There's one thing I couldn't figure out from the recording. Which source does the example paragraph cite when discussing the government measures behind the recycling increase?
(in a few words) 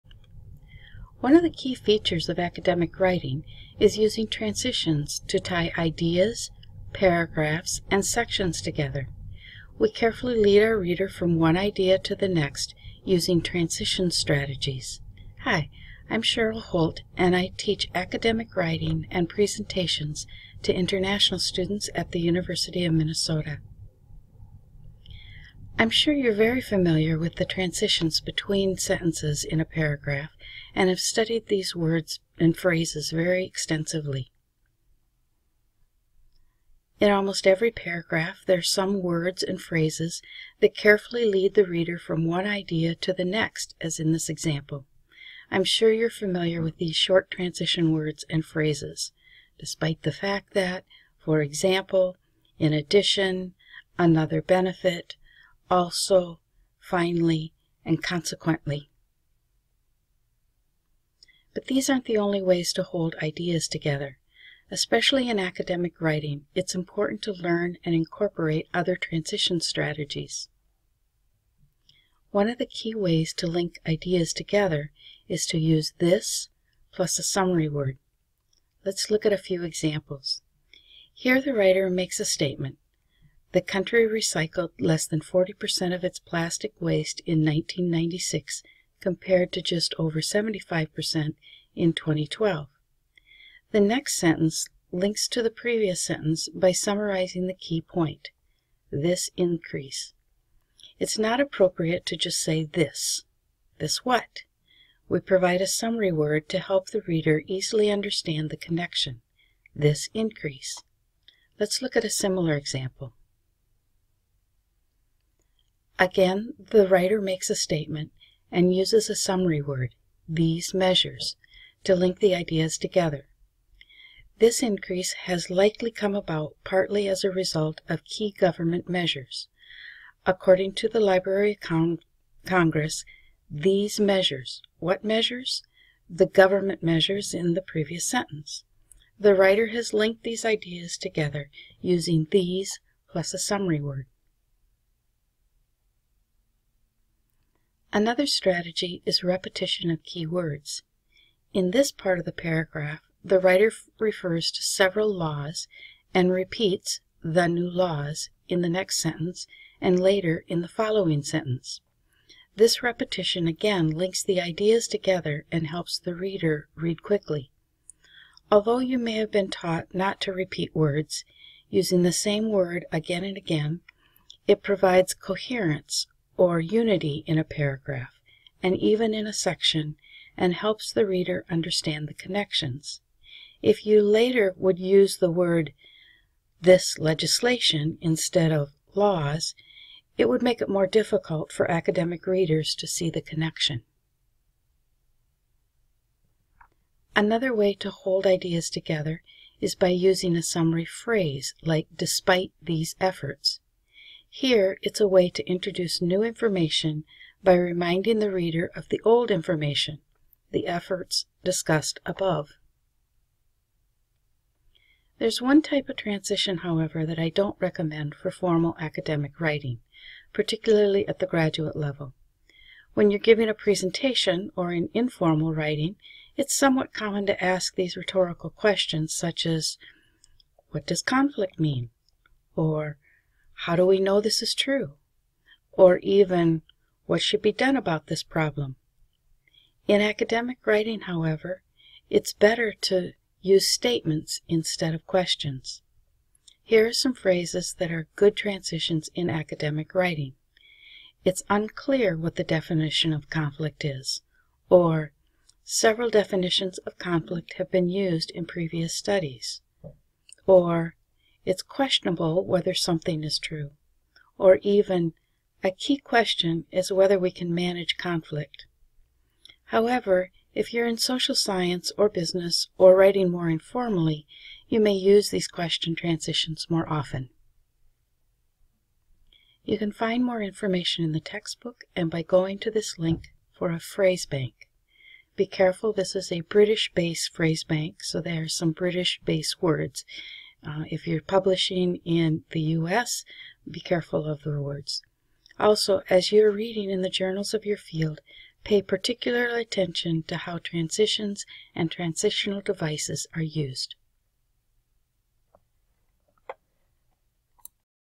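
Library of Congress.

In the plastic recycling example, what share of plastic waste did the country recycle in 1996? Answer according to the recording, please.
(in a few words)
less than 40%.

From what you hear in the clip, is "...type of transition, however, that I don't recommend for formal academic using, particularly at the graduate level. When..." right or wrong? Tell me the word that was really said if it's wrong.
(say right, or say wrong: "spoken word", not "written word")
wrong: "writing", not "using".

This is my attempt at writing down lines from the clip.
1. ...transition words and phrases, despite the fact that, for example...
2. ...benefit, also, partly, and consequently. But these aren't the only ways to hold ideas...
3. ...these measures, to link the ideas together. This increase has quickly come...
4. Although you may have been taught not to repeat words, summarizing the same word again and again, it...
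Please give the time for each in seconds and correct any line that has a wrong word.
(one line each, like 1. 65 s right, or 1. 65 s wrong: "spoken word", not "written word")
1. 47 s right
2. 54 s wrong: "finally", not "partly"
3. 120 s wrong: "likely", not "quickly"
4. 168 s wrong: "using", not "summarizing".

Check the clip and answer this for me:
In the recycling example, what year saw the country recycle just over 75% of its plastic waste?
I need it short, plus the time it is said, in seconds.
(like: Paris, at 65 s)
2012, at 91 s.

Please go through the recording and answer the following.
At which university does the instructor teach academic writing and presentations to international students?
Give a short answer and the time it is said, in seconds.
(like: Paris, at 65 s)
University of Minnesota, at 22 s.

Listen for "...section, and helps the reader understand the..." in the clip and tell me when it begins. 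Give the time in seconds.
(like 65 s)
179 s.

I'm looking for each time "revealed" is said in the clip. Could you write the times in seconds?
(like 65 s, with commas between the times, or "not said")
not said.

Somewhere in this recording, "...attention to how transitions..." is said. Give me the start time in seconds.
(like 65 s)
299 s.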